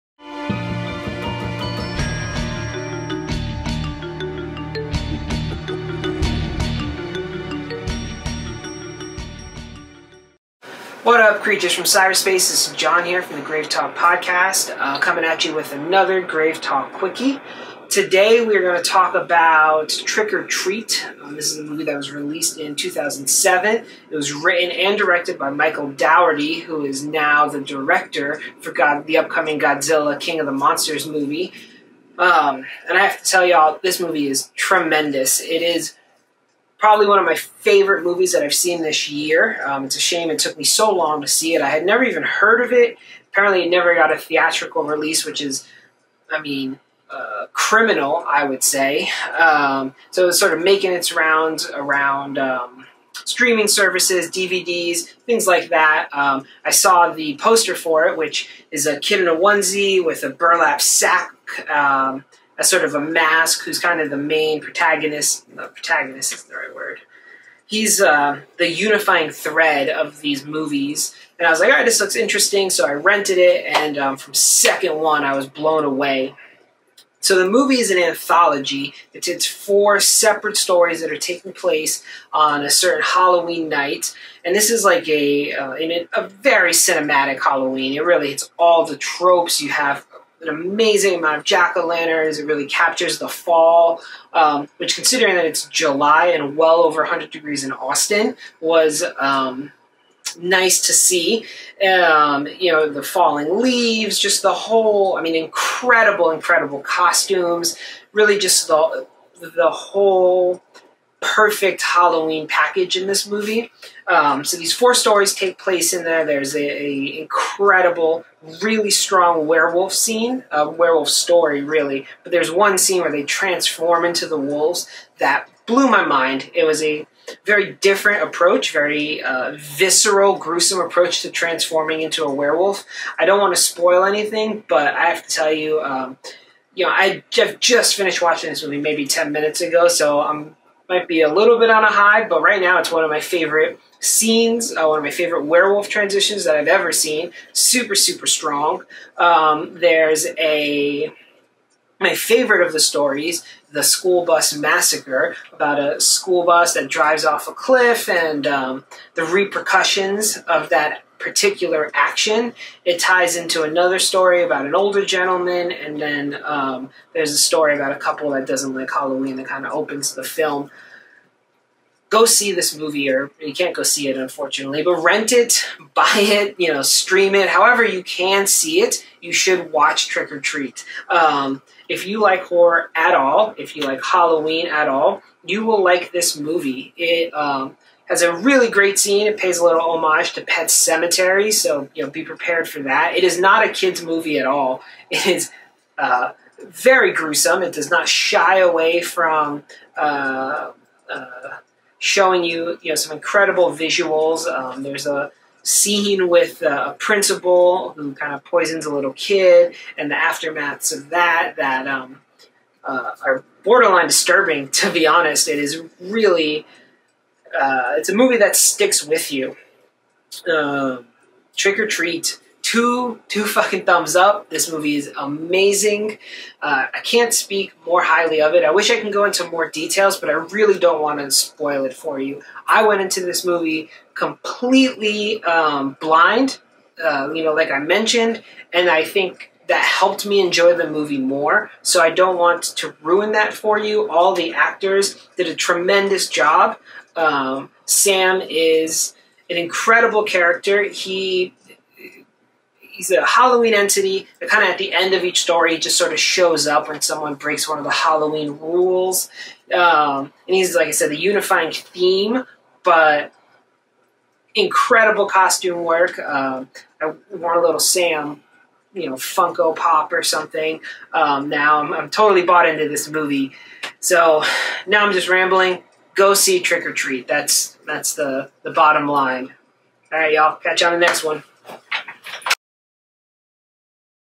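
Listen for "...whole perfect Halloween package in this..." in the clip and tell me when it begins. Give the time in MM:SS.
01:49.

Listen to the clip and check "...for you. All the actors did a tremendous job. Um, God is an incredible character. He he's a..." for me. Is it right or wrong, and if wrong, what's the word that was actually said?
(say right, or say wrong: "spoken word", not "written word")
wrong: "Sam", not "God".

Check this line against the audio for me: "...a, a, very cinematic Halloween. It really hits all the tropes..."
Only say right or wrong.
right.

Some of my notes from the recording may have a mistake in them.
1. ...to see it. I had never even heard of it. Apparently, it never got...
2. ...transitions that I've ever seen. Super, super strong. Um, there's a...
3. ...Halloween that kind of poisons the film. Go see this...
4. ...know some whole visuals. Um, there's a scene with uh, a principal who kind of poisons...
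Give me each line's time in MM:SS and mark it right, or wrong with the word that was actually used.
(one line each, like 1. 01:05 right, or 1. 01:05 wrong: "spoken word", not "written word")
1. 00:41 right
2. 02:25 right
3. 02:48 wrong: "opens", not "poisons"
4. 03:22 wrong: "incredible", not "whole".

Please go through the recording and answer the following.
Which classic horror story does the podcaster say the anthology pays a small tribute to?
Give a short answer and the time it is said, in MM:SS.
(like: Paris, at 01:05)
Pet Sematary, at 03:10.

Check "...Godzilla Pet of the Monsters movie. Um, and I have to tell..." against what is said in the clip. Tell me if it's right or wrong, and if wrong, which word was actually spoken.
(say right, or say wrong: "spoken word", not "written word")
wrong: "King", not "Pet".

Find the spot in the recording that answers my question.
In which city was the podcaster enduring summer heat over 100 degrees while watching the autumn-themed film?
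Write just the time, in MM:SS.
01:37.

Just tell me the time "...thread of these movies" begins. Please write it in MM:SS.
01:09.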